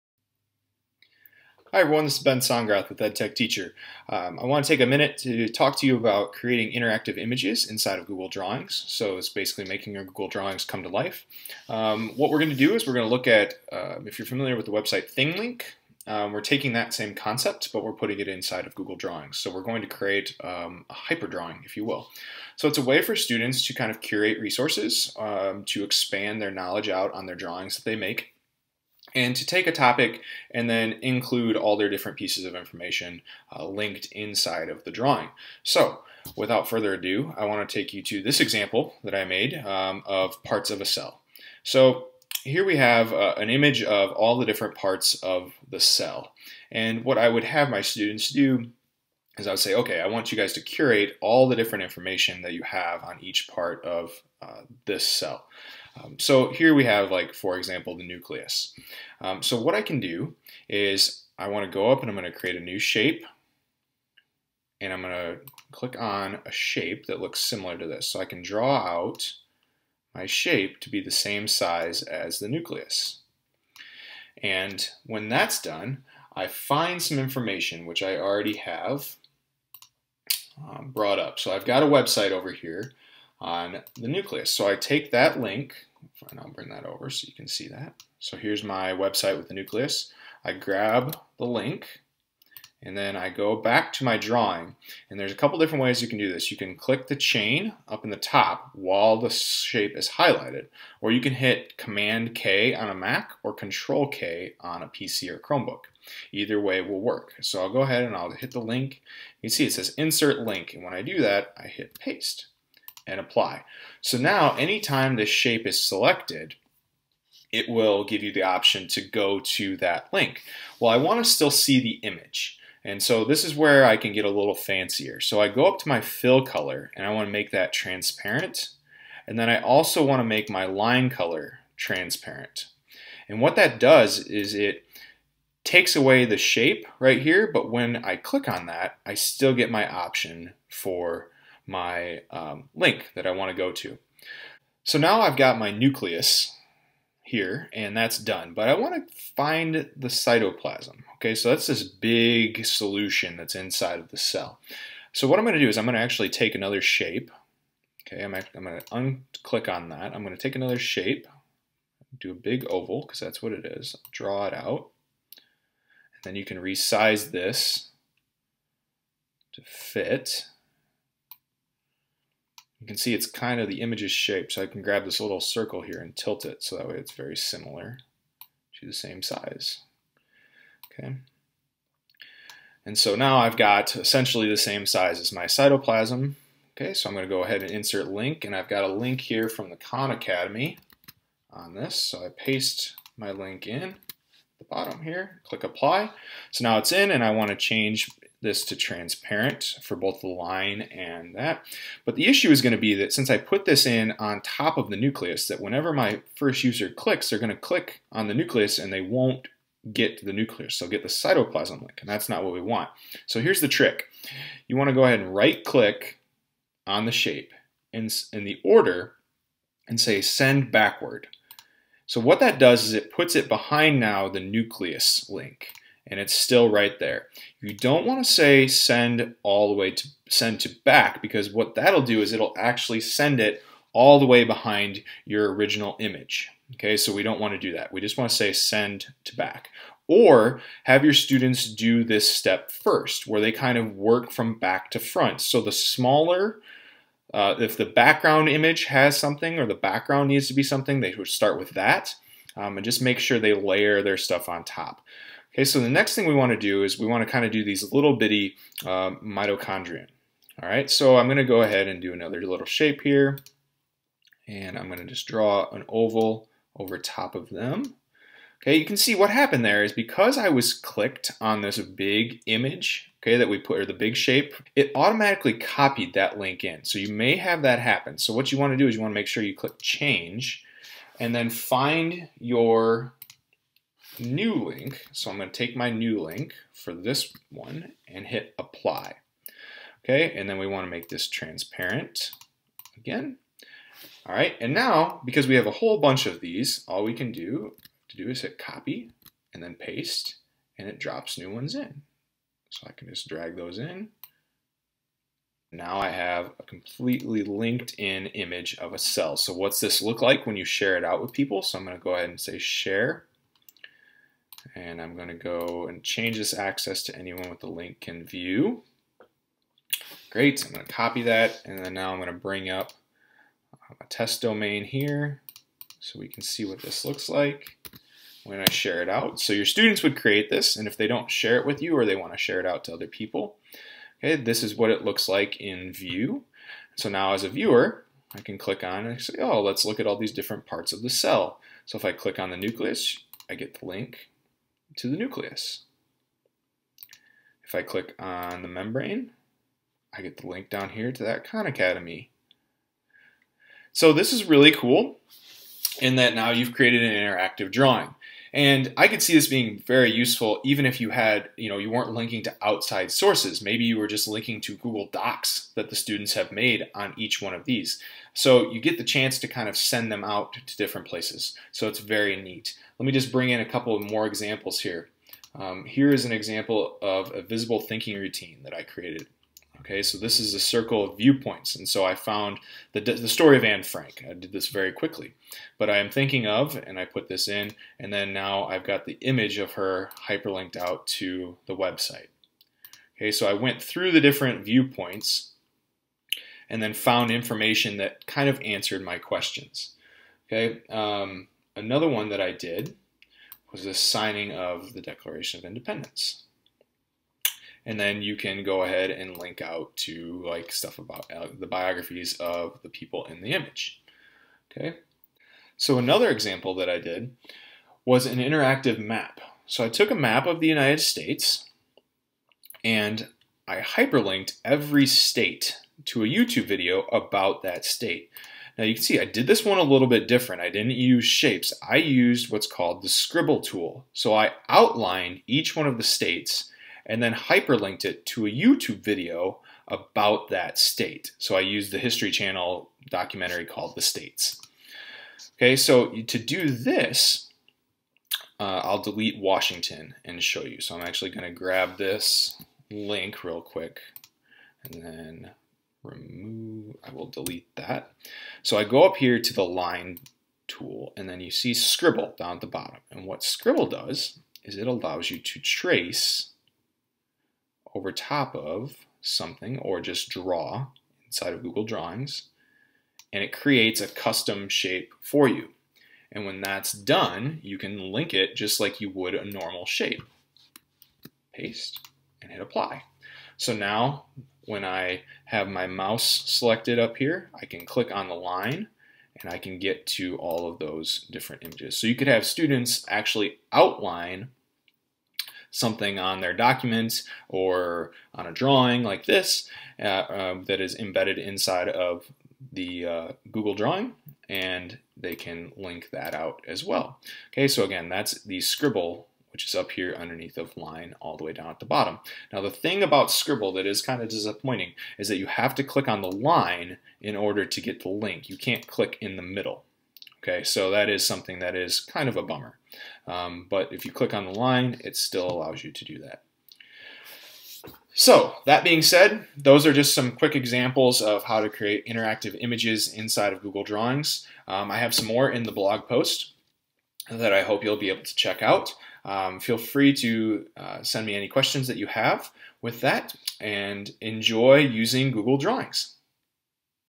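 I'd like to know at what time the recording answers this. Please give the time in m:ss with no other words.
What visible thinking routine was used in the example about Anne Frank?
6:20.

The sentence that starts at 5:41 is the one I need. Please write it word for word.
So if I click on the nucleus, I get the link to the nucleus.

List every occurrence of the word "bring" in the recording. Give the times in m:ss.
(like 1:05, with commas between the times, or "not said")
1:26, 5:22, 6:13.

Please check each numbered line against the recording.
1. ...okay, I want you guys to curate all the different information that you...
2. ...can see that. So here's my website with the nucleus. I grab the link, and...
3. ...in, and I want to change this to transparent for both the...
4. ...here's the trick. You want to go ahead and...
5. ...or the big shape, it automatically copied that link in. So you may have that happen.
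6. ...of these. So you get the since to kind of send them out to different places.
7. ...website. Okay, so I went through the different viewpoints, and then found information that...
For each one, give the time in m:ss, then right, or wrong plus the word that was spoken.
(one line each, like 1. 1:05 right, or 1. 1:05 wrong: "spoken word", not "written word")
1. 0:49 right
2. 1:27 right
3. 3:16 right
4. 3:33 right
5. 4:33 right
6. 6:07 wrong: "chance", not "since"
7. 6:31 right.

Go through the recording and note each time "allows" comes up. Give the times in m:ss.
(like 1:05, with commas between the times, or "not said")
7:44, 8:45.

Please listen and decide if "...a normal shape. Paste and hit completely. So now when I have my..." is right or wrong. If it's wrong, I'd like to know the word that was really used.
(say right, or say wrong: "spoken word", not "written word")
wrong: "apply", not "completely".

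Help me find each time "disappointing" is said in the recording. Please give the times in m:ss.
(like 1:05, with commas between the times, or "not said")
8:34.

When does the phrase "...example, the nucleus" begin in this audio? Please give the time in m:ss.
0:57.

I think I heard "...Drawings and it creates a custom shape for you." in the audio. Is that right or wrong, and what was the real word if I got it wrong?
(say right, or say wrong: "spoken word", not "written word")
right.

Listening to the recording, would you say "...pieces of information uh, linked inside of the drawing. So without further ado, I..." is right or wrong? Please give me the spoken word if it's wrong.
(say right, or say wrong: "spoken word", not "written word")
right.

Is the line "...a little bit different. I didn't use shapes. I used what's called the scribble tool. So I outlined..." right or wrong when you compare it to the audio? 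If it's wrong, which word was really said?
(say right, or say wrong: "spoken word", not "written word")
right.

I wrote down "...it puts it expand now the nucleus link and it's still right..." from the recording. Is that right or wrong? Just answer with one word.
wrong.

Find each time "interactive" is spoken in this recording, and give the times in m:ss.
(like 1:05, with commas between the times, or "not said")
0:06, 5:57, 6:58, 8:52.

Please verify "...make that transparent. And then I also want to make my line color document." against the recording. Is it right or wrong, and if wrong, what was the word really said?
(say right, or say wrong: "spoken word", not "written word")
wrong: "transparent", not "document".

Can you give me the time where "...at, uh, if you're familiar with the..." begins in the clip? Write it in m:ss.
0:13.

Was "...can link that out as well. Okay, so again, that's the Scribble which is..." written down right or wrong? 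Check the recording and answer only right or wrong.
right.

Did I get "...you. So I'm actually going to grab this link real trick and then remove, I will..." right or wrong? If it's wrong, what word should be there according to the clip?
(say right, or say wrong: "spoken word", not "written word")
wrong: "quick", not "trick".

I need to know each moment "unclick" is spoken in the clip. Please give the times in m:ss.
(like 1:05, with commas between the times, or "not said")
2:39.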